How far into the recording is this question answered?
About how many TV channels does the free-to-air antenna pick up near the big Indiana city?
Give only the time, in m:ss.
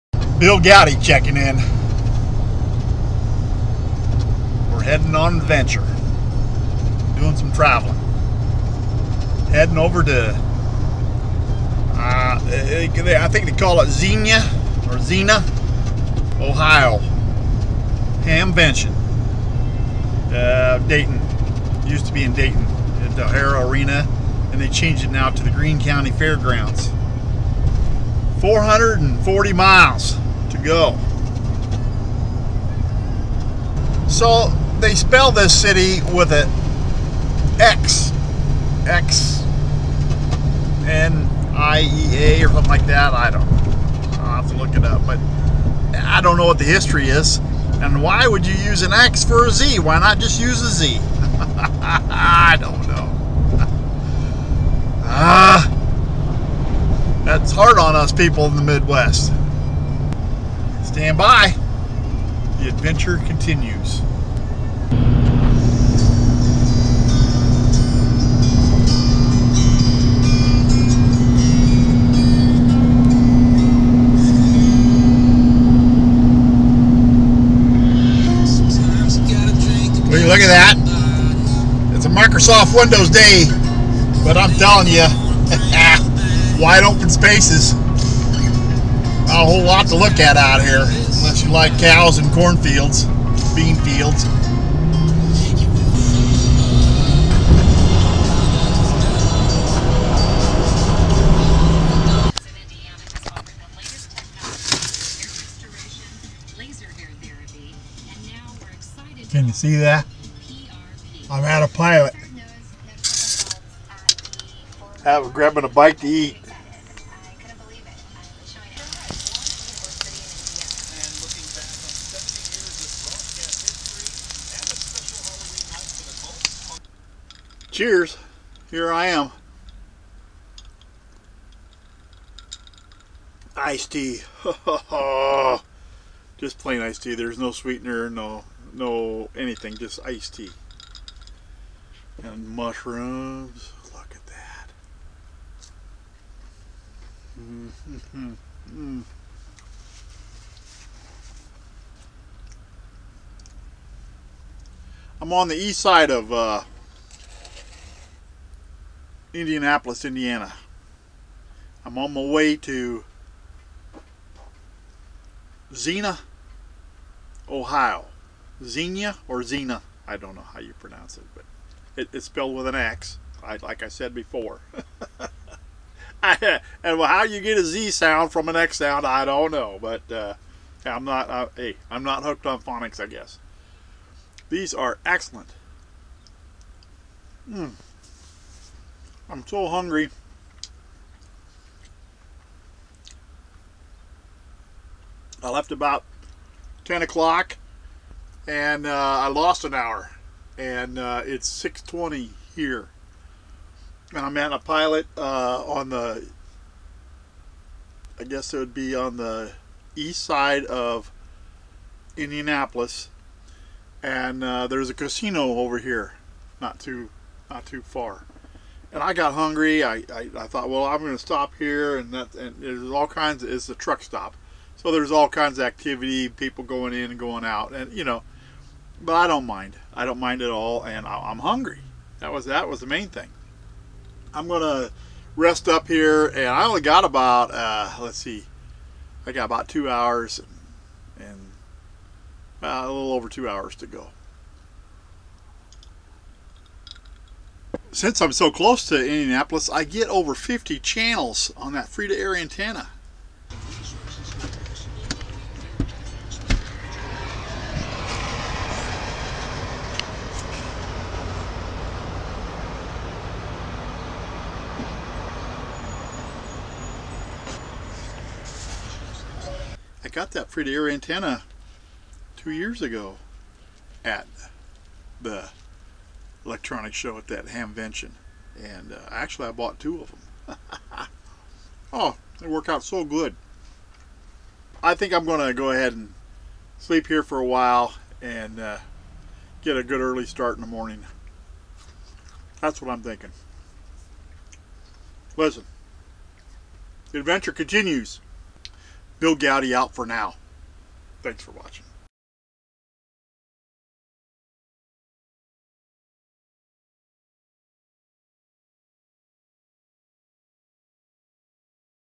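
4:10.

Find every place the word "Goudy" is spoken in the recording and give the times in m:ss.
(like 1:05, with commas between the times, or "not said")
0:00, 4:59.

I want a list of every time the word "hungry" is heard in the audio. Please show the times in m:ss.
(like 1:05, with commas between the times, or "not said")
3:09, 3:39, 3:51.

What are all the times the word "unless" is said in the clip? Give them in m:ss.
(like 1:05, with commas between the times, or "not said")
1:30.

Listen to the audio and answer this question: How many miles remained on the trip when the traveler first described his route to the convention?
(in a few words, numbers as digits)
440.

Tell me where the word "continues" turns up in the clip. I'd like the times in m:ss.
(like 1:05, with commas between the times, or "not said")
1:03, 4:57.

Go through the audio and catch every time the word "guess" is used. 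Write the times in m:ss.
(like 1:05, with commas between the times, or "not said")
3:03, 3:28.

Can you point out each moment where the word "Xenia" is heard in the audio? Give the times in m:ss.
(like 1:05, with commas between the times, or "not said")
0:13, 2:48.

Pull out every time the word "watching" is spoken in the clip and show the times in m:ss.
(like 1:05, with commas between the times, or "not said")
5:01.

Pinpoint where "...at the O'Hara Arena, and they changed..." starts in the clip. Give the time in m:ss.
0:23.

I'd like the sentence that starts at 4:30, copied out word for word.
I got that free-to-air antenna two years ago at the electronics show at that Hamvention.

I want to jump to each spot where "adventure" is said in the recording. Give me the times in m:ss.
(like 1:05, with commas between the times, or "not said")
0:05, 1:02, 4:57.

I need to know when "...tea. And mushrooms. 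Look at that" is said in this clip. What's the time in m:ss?
2:20.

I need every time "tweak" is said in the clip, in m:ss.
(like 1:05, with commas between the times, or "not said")
not said.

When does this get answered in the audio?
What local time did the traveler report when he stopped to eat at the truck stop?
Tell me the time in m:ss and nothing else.
3:21.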